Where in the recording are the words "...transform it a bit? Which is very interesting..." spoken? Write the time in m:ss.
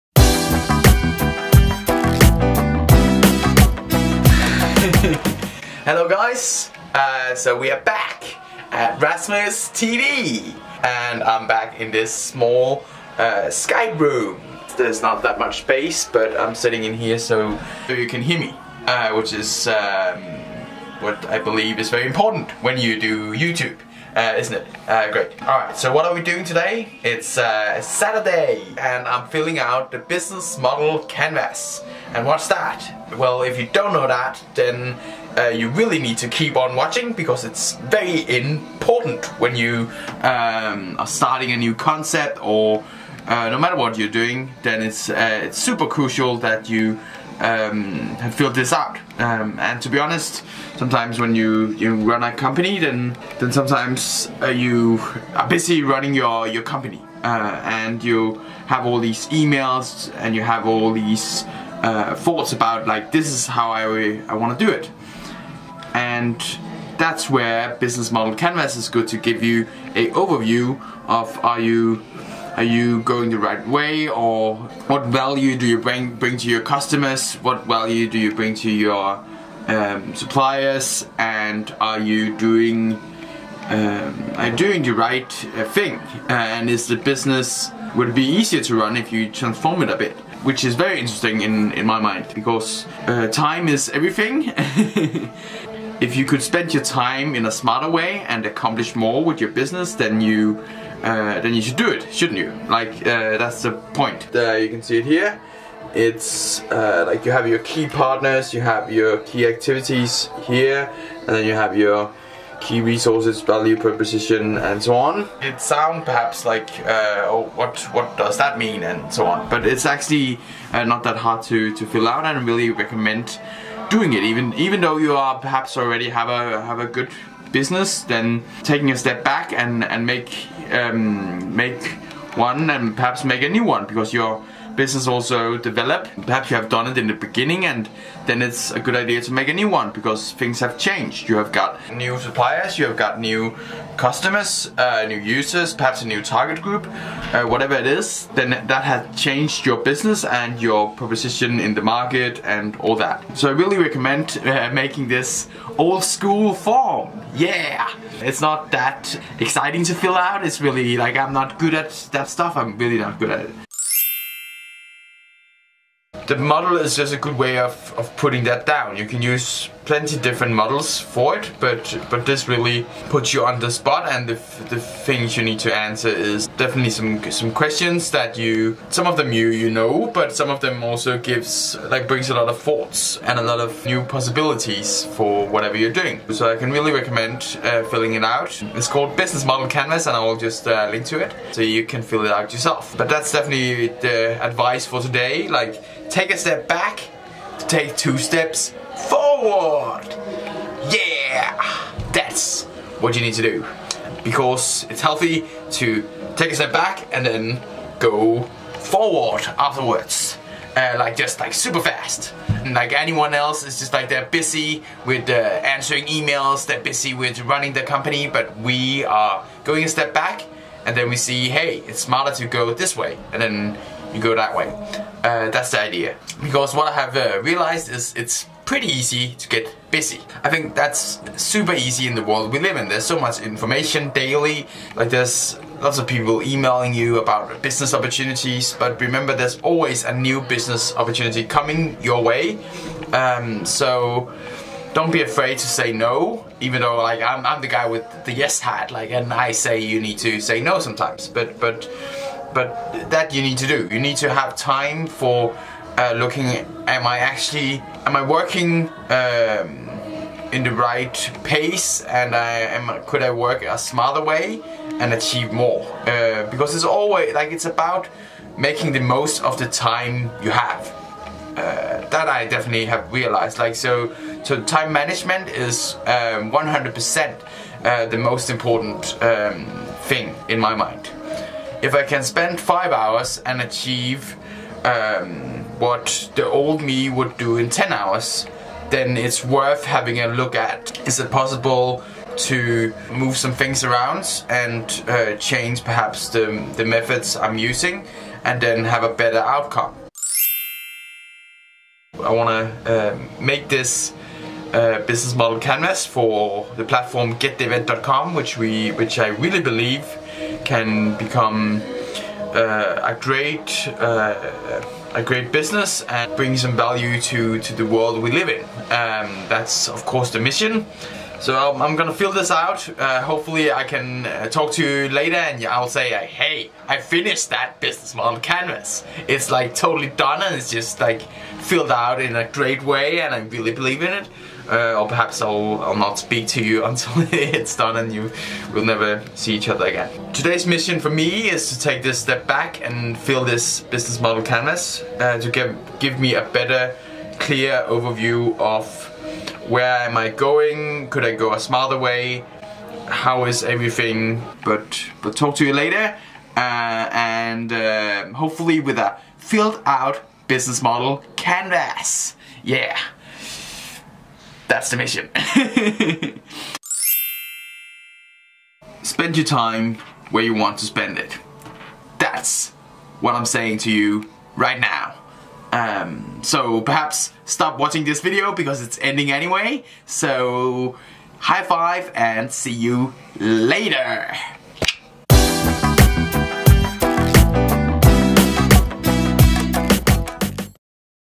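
1:29.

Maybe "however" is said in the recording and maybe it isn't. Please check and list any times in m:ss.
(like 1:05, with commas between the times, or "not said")
not said.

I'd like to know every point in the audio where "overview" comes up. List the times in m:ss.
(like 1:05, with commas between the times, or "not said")
1:10, 5:47.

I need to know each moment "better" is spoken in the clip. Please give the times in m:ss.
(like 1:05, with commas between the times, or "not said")
4:59, 5:46.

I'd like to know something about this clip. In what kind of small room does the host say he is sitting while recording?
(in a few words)
Skype room.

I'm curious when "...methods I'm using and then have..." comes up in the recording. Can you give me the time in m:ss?
4:56.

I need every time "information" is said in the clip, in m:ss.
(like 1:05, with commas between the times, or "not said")
3:53.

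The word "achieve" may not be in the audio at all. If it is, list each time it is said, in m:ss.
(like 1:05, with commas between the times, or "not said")
4:25, 4:43.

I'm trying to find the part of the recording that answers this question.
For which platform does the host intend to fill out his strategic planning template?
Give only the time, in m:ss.
5:07.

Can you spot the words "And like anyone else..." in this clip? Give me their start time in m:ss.
3:32.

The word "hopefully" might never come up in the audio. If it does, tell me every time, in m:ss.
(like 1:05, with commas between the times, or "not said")
5:23, 5:58.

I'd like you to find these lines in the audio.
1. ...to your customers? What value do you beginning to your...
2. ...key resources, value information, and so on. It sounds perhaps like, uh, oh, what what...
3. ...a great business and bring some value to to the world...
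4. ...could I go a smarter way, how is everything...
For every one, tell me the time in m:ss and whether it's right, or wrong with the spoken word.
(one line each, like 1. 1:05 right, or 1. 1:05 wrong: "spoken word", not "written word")
1. 1:16 wrong: "bring", not "beginning"
2. 1:52 wrong: "proposition", not "information"
3. 5:15 right
4. 5:51 right.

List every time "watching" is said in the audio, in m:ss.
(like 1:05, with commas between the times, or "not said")
0:36, 6:17.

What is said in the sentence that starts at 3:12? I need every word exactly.
But that's definitely the advice for today.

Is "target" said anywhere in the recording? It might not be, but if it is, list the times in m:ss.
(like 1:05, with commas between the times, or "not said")
2:26.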